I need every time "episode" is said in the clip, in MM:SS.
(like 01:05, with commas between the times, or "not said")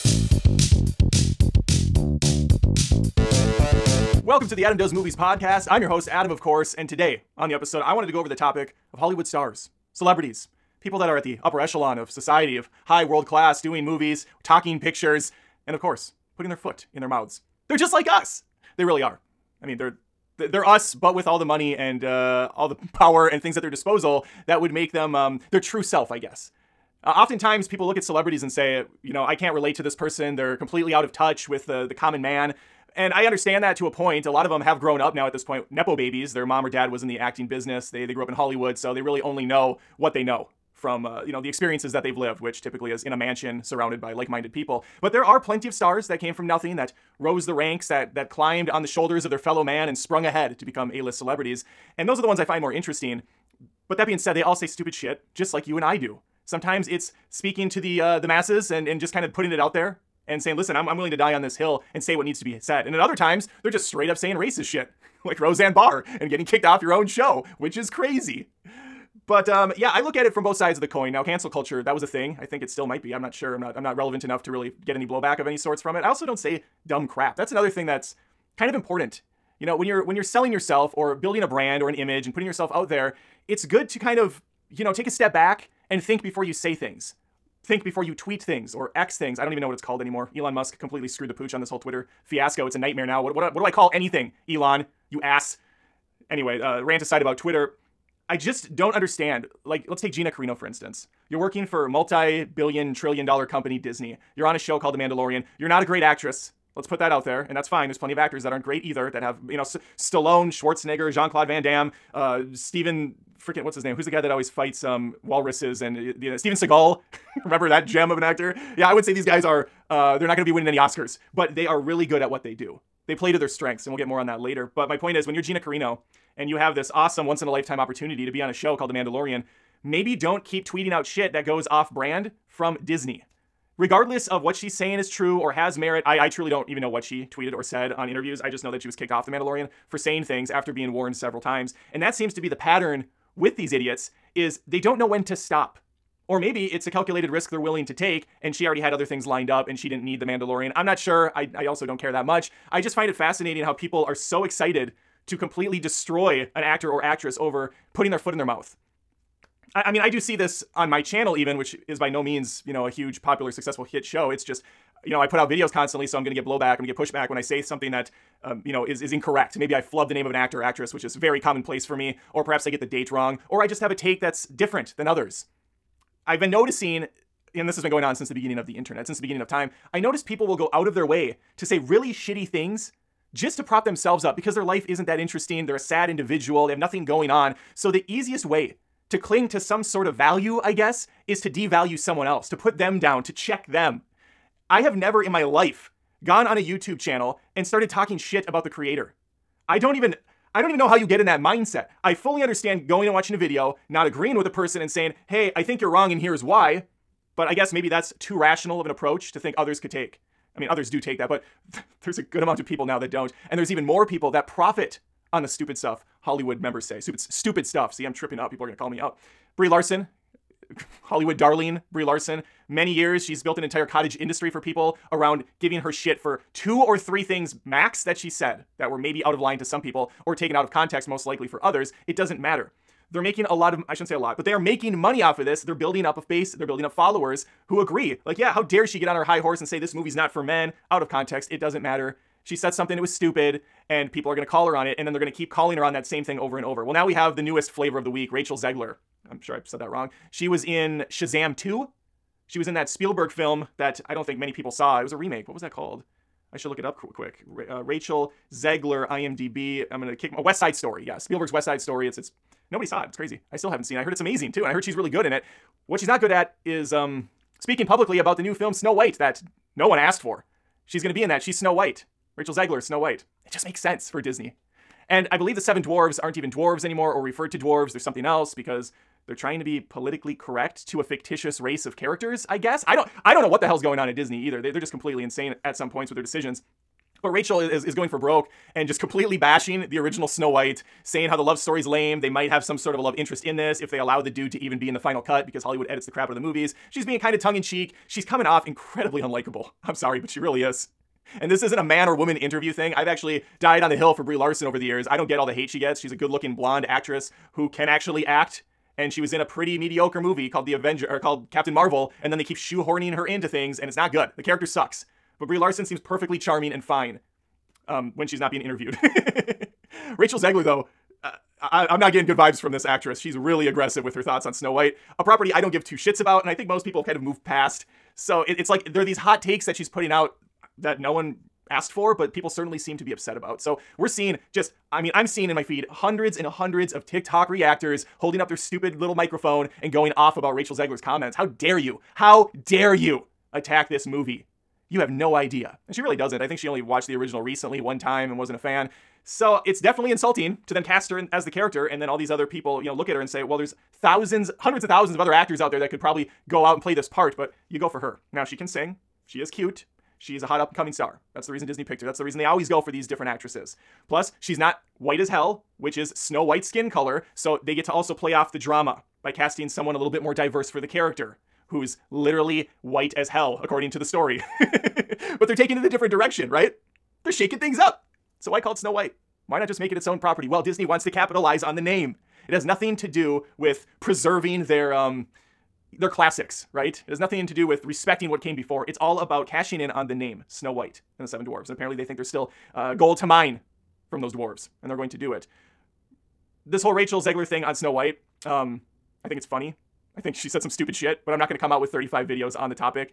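00:07.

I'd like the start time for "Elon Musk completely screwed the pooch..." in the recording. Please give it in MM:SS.
01:30.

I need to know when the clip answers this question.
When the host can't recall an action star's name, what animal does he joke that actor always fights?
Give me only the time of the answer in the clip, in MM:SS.
01:55.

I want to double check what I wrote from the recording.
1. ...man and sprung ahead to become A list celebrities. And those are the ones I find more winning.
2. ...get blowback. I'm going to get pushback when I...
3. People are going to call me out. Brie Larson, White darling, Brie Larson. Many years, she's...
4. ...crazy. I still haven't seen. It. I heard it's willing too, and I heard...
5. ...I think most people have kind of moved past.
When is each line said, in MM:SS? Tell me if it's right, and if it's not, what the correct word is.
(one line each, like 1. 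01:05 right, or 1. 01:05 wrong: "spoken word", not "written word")
1. 00:49 wrong: "interesting", not "winning"
2. 02:46 right
3. 03:38 wrong: "Hollywood", not "White"
4. 04:23 wrong: "amazing", not "willing"
5. 05:26 right.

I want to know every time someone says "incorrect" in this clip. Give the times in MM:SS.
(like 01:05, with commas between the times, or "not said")
02:49.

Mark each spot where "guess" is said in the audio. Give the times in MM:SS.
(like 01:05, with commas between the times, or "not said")
00:26, 03:10, 03:27, 04:42.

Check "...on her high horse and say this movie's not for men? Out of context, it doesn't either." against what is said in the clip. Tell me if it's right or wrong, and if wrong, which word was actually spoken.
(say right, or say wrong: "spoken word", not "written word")
wrong: "matter", not "either".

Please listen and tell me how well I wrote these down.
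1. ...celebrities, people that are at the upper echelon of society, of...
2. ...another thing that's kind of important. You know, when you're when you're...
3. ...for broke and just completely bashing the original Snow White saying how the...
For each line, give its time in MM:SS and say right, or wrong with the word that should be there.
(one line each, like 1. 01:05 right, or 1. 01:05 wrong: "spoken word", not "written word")
1. 00:09 right
2. 01:17 right
3. 04:48 right.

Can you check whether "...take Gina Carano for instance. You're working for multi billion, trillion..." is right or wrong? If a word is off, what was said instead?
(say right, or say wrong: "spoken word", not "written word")
right.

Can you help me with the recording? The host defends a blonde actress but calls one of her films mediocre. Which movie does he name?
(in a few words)
Captain Marvel.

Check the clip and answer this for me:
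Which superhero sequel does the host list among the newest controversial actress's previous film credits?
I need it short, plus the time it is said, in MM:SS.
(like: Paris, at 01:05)
Shazam 2, at 04:11.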